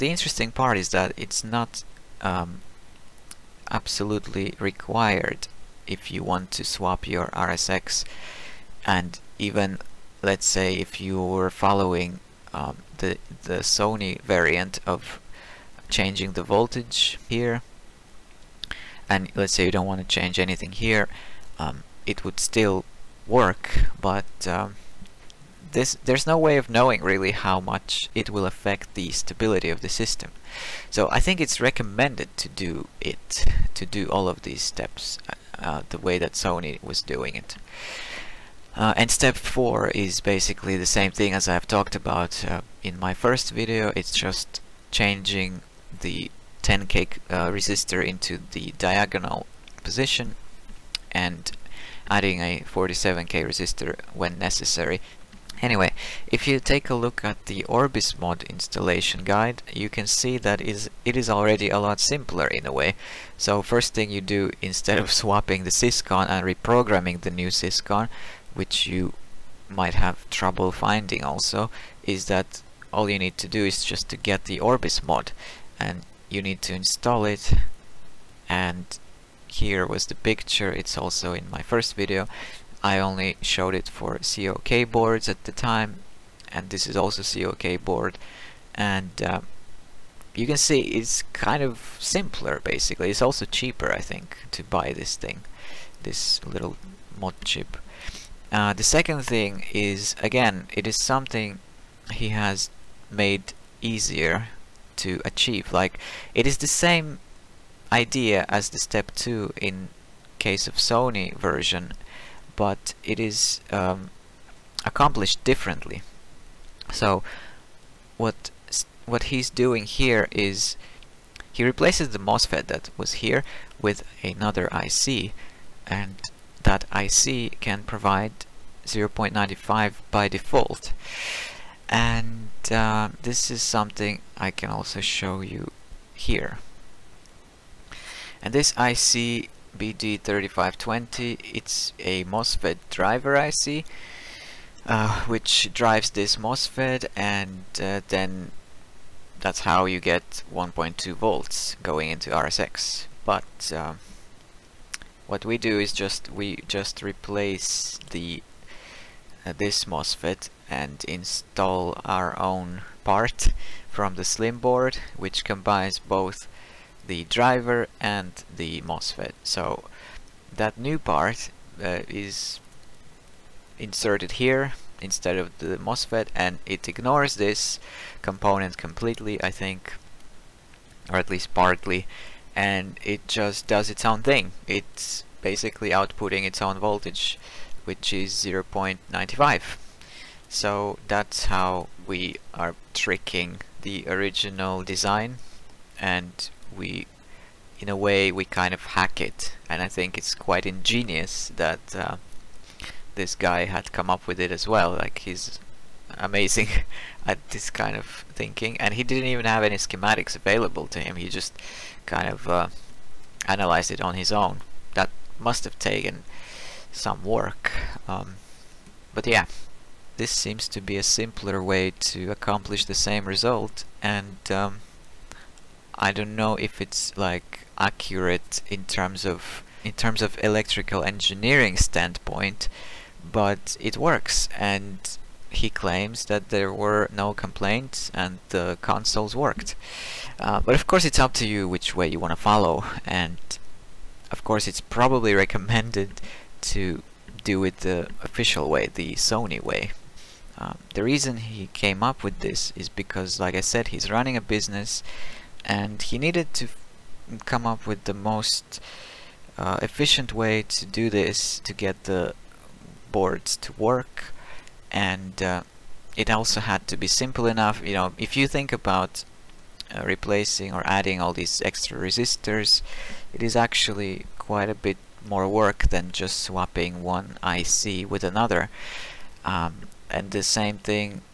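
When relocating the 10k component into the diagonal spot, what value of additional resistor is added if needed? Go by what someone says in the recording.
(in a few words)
47k.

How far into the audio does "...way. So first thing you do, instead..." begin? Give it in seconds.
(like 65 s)
62 s.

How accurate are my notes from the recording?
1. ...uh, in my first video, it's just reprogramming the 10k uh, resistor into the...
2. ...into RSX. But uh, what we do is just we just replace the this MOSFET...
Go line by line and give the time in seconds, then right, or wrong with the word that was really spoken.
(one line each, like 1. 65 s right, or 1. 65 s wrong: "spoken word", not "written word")
1. 42 s wrong: "changing", not "reprogramming"
2. 152 s right.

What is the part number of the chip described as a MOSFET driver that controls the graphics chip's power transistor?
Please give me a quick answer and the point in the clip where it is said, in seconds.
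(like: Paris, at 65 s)
BD3520, at 139 s.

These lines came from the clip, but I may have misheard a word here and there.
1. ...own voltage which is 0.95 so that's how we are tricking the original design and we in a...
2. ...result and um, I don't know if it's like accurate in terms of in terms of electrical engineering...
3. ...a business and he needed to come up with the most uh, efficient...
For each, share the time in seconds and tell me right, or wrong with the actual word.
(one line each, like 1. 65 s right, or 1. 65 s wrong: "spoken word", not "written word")
1. 186 s right
2. 223 s right
3. 254 s right.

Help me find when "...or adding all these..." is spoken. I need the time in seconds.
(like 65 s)
270 s.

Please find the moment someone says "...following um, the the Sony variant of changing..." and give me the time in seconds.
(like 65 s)
11 s.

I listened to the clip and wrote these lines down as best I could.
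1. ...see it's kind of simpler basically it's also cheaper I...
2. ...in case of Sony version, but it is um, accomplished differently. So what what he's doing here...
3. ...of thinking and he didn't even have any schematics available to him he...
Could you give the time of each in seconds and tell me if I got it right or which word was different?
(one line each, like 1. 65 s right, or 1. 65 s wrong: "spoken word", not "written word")
1. 90 s right
2. 109 s right
3. 207 s right.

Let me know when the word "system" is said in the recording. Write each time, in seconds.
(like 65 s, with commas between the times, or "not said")
29 s.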